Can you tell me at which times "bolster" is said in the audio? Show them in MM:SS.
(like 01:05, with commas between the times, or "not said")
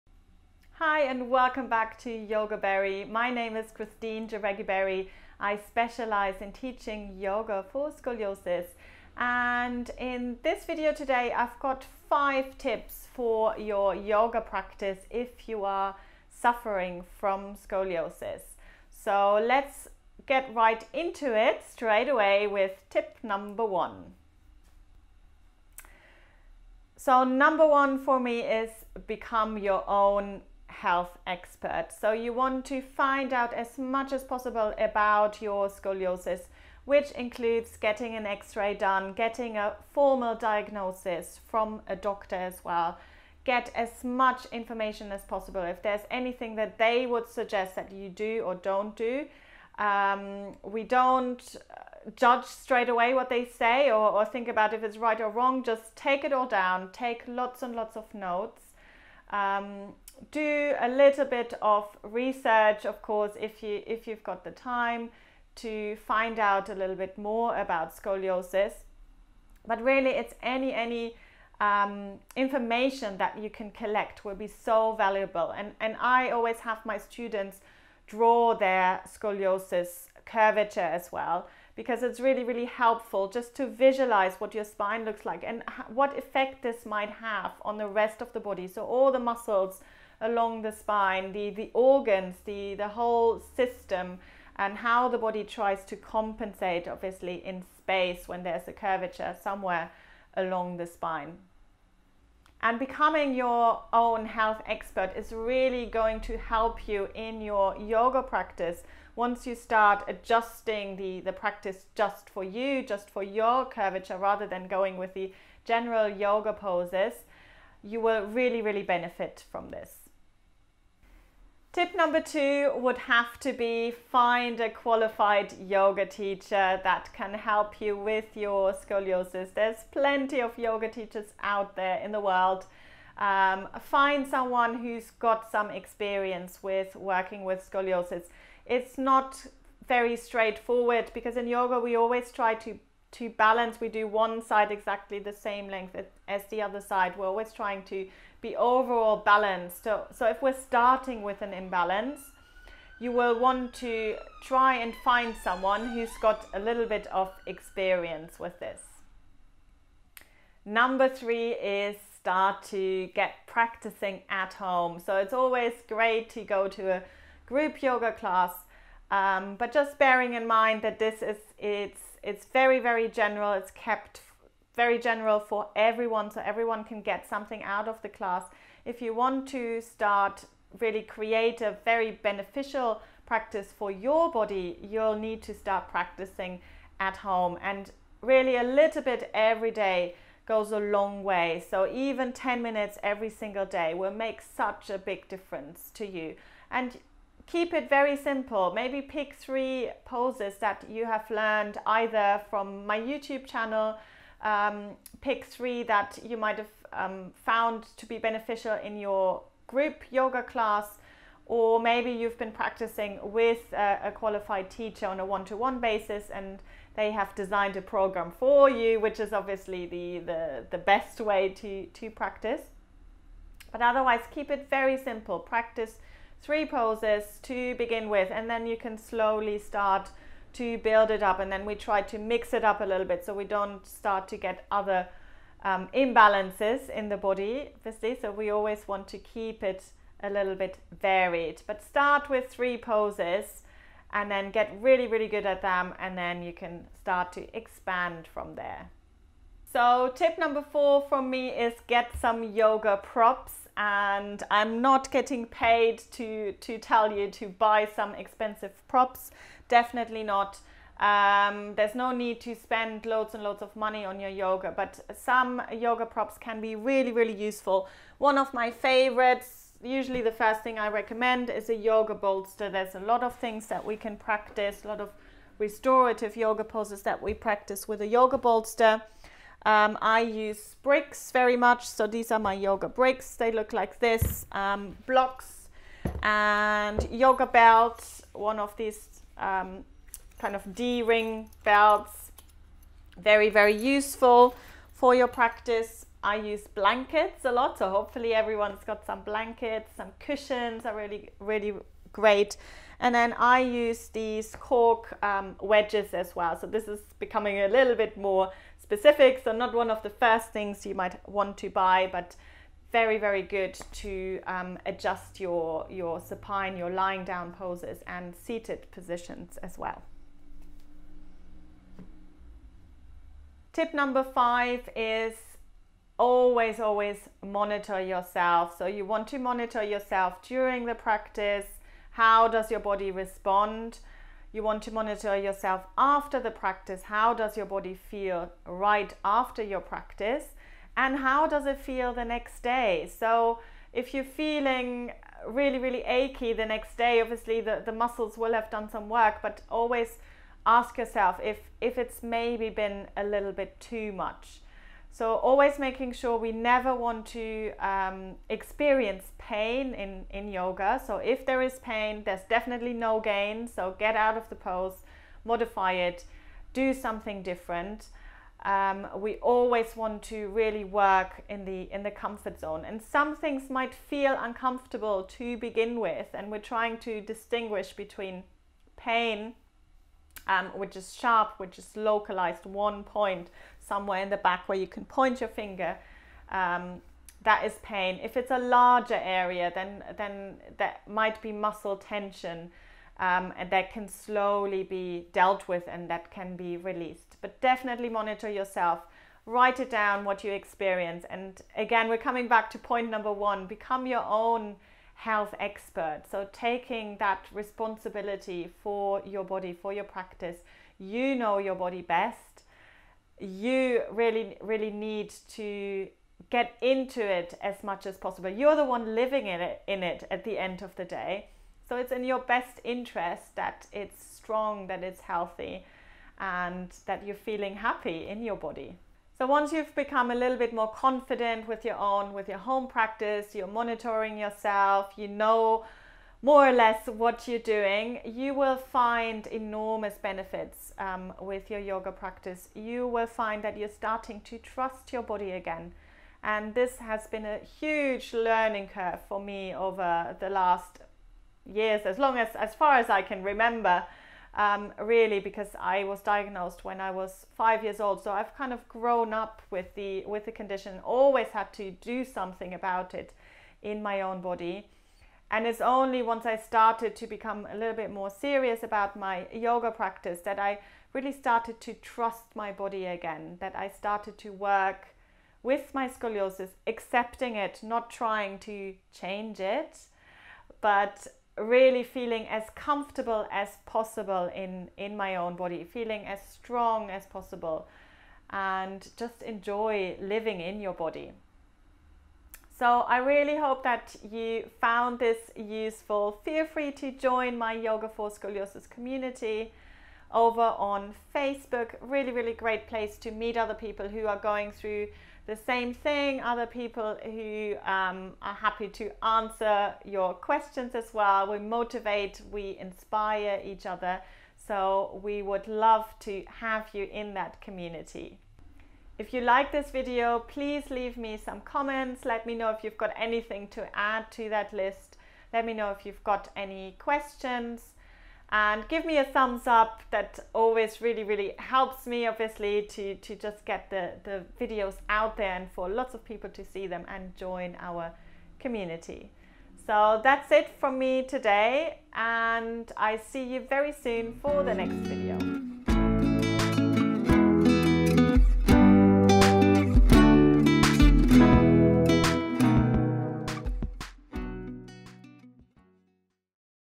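04:32, 04:38.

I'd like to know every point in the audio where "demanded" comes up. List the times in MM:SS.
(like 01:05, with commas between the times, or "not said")
not said.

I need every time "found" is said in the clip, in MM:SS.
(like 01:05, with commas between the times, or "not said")
03:27, 08:14.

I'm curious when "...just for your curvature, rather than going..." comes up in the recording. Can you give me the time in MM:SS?
01:52.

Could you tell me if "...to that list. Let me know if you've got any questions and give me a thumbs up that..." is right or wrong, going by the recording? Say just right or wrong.
right.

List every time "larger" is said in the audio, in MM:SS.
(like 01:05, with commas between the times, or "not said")
06:28.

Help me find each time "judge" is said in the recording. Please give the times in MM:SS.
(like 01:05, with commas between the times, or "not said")
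00:52.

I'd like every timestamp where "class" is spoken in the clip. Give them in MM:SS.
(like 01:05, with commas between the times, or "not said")
02:48, 02:58, 03:30.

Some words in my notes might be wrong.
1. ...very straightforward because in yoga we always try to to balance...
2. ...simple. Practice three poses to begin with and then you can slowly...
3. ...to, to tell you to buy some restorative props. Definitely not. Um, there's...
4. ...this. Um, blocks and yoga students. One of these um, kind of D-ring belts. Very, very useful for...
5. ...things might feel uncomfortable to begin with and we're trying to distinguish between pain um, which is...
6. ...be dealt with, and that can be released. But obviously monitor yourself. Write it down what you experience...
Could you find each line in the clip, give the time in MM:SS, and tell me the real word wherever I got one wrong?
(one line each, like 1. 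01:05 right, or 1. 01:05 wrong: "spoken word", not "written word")
1. 02:19 right
2. 03:44 right
3. 04:16 wrong: "expensive", not "restorative"
4. 04:43 wrong: "belts", not "students"
5. 06:13 right
6. 06:34 wrong: "definitely", not "obviously".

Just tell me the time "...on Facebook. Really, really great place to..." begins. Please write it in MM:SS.
08:20.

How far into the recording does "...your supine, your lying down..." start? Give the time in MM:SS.
05:15.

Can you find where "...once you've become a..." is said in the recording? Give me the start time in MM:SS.
07:09.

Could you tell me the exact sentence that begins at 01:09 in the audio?
But really, it's any any um, information that you can collect will be so valuable.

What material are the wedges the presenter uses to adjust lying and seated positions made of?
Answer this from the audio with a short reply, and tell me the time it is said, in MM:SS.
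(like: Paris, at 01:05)
cork, at 05:04.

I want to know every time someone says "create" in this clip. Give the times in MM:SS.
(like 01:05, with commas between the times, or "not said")
03:01.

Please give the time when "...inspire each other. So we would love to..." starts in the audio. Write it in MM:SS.
08:32.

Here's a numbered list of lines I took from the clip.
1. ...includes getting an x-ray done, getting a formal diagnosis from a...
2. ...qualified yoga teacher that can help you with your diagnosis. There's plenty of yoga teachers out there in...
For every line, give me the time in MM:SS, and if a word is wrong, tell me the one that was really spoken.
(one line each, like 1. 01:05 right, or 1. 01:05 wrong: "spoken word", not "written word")
1. 00:37 right
2. 02:04 wrong: "scoliosis", not "diagnosis".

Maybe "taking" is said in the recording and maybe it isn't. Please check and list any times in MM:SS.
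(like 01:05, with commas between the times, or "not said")
06:46.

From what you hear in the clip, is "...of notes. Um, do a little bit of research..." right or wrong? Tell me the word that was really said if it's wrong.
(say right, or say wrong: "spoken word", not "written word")
right.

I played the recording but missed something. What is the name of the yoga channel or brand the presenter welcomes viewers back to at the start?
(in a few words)
Yogaberry.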